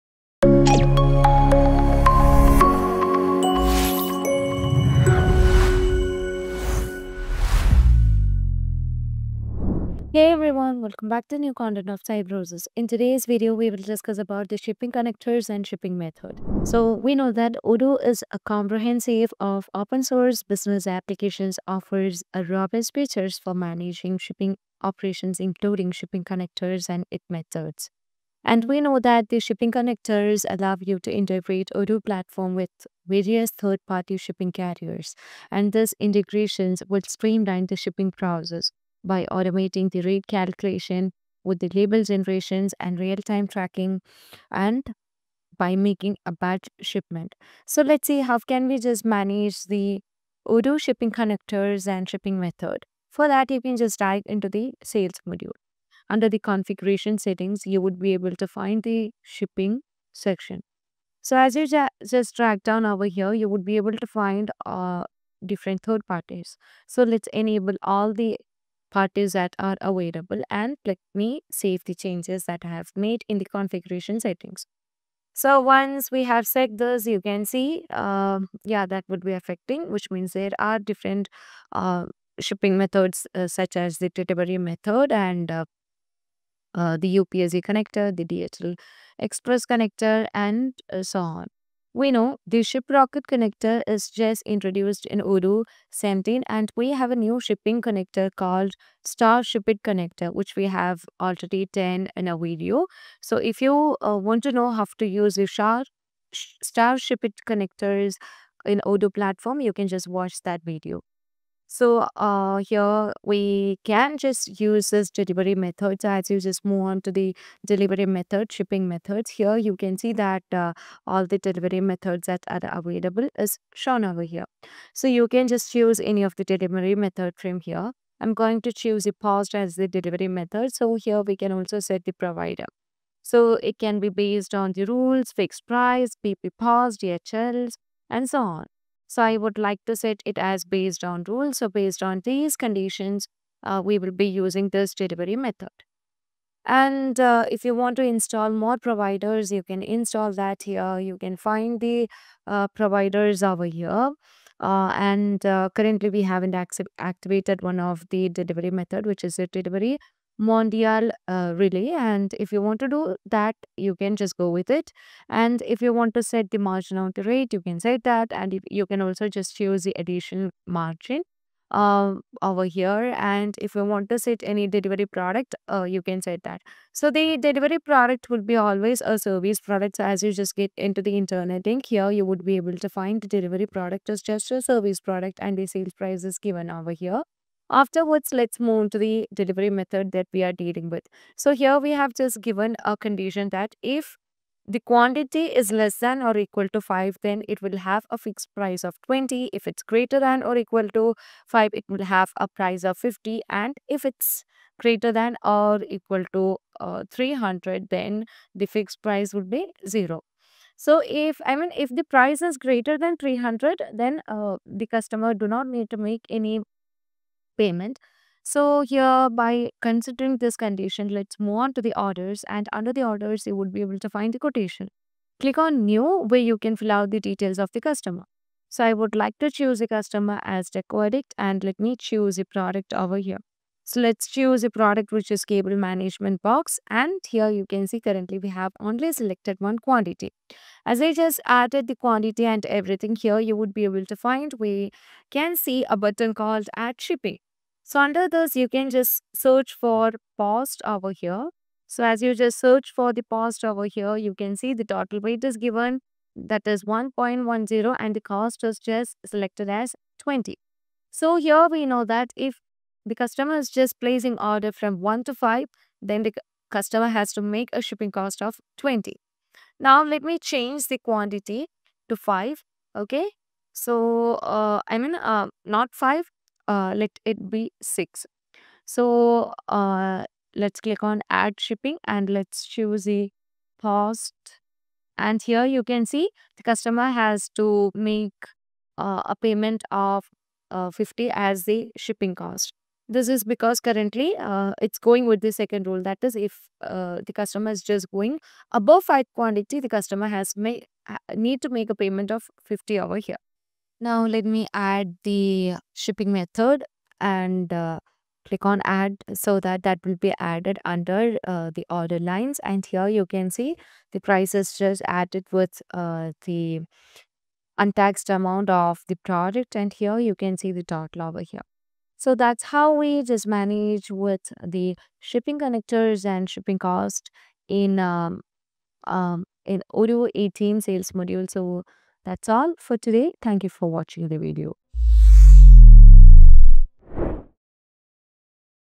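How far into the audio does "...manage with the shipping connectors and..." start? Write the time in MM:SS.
05:23.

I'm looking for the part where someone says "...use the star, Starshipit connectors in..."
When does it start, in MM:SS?
01:45.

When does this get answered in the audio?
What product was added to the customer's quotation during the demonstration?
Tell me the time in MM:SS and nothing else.
03:55.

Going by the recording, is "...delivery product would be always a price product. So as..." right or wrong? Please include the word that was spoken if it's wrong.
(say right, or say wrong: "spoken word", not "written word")
wrong: "service", not "price".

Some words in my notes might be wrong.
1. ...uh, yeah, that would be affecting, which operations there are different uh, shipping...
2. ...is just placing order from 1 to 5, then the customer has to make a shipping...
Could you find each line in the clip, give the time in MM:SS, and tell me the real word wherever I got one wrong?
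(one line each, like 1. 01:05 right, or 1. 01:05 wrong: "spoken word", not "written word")
1. 01:17 wrong: "means", not "operations"
2. 04:23 right.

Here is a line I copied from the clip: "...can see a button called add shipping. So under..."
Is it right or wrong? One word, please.
right.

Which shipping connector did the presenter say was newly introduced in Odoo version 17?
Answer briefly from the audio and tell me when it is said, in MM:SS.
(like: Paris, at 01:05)
Shiprocket, at 01:32.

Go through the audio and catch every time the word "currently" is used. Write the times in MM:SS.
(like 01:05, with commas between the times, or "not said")
02:35, 03:57, 04:53.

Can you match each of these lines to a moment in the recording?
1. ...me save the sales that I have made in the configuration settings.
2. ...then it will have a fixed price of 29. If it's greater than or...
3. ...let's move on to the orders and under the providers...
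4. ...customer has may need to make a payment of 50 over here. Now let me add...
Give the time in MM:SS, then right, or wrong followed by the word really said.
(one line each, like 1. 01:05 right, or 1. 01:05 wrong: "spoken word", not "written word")
1. 01:11 wrong: "changes", not "sales"
2. 03:17 wrong: "20", not "29"
3. 03:41 wrong: "orders", not "providers"
4. 04:59 right.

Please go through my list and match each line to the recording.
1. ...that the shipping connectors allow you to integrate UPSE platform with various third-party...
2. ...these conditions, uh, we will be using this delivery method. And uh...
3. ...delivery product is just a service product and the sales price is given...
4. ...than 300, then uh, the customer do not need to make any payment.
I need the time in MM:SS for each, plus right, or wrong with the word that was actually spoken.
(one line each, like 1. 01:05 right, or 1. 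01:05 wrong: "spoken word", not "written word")
1. 00:28 wrong: "Odoo", not "UPSE"
2. 02:22 right
3. 03:03 right
4. 03:32 right.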